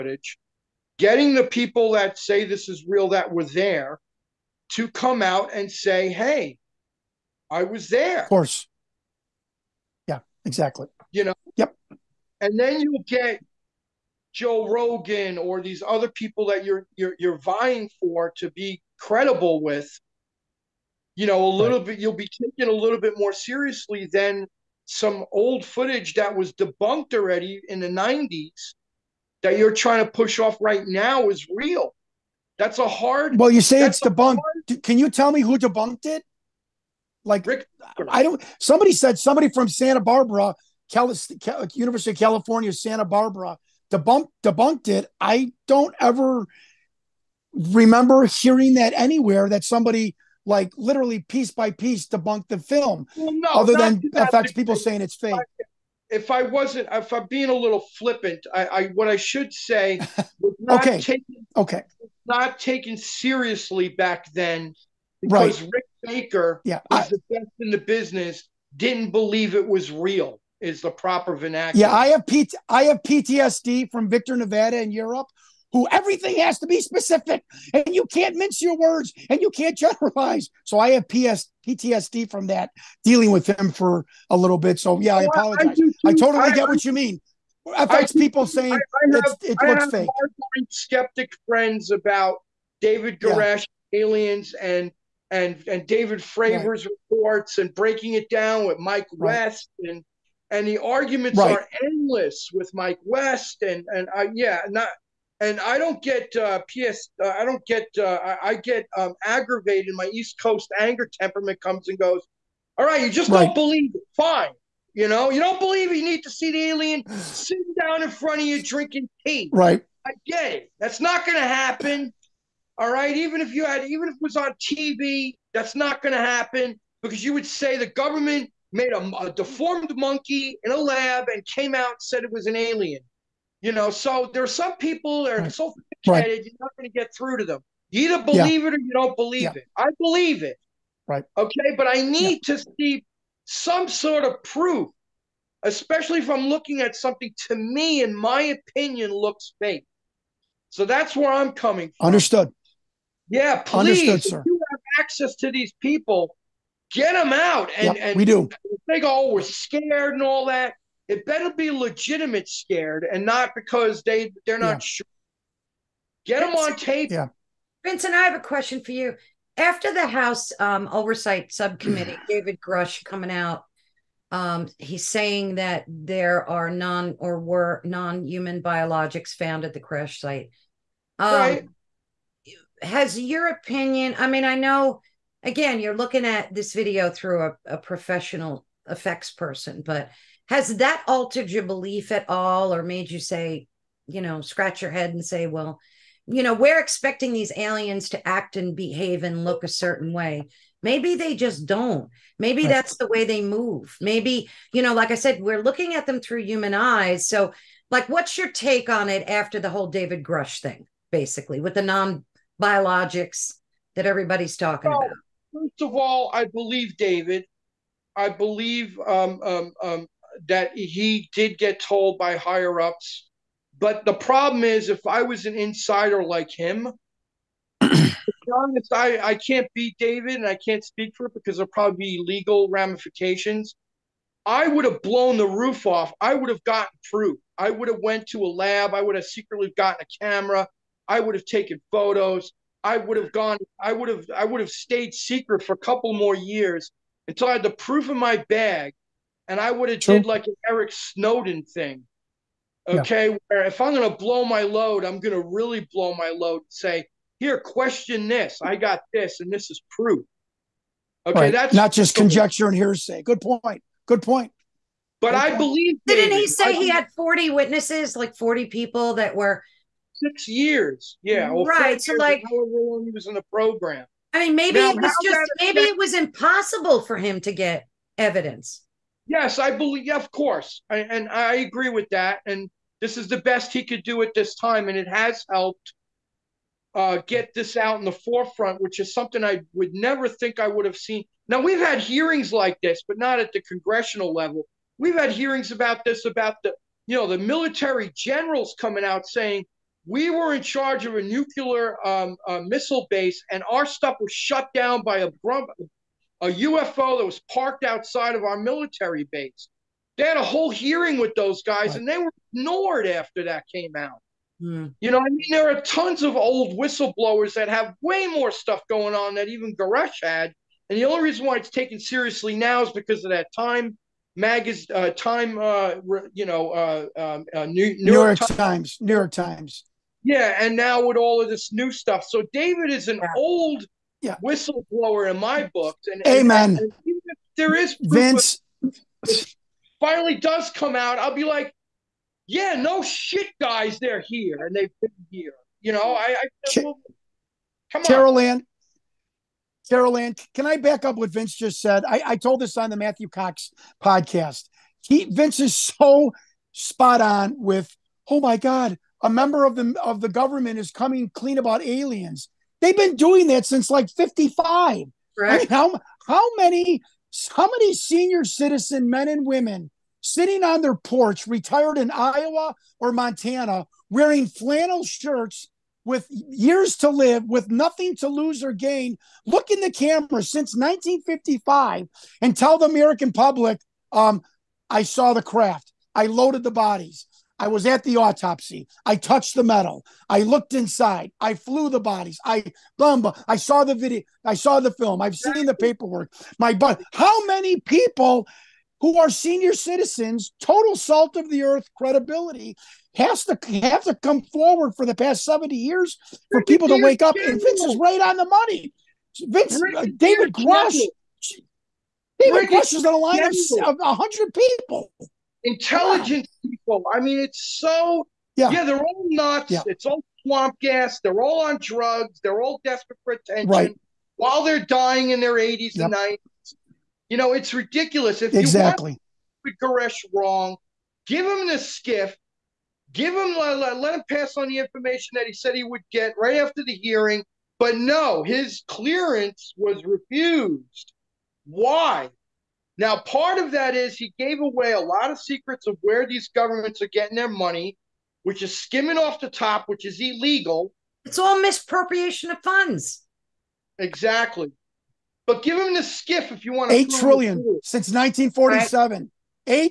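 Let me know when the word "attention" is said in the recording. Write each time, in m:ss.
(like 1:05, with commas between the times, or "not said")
7:03.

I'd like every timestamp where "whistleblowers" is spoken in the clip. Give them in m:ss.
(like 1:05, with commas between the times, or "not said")
5:16, 5:34.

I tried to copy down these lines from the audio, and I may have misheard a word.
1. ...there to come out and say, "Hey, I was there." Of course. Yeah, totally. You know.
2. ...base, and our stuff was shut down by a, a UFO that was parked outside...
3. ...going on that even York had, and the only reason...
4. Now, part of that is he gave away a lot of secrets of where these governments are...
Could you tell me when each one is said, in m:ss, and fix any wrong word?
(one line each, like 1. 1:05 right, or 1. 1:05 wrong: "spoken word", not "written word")
1. 0:03 wrong: "exactly", not "totally"
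2. 5:03 right
3. 5:18 wrong: "Grusch", not "York"
4. 7:22 right.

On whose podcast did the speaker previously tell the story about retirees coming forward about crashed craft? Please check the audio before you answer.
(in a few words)
Matthew Cox.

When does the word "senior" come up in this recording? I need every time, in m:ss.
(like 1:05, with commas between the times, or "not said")
6:07, 6:39.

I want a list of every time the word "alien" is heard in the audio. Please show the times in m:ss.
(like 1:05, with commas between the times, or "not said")
1:34, 1:56, 2:12, 3:17, 6:01.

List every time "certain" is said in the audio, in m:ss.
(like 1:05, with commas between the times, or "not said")
3:19.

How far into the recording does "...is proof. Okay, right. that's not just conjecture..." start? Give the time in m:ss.
4:19.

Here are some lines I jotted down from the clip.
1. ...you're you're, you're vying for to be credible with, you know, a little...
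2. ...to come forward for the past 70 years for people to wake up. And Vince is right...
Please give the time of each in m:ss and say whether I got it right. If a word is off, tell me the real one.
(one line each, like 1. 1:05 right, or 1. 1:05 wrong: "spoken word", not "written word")
1. 0:16 right
2. 6:44 right.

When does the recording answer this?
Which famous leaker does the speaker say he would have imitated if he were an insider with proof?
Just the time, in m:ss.
4:10.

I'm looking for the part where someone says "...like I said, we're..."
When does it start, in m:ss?
3:24.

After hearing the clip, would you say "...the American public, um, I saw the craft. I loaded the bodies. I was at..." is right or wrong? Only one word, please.
right.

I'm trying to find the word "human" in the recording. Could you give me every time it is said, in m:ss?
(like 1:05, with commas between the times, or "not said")
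2:58, 3:26.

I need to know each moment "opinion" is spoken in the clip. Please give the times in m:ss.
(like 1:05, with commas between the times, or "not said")
2:28, 3:03.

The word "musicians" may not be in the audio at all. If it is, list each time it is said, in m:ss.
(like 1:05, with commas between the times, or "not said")
not said.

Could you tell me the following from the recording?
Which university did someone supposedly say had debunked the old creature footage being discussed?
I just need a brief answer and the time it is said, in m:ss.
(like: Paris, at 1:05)
University of California, Santa Barbara, at 0:41.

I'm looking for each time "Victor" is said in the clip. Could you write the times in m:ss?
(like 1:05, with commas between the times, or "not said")
1:14.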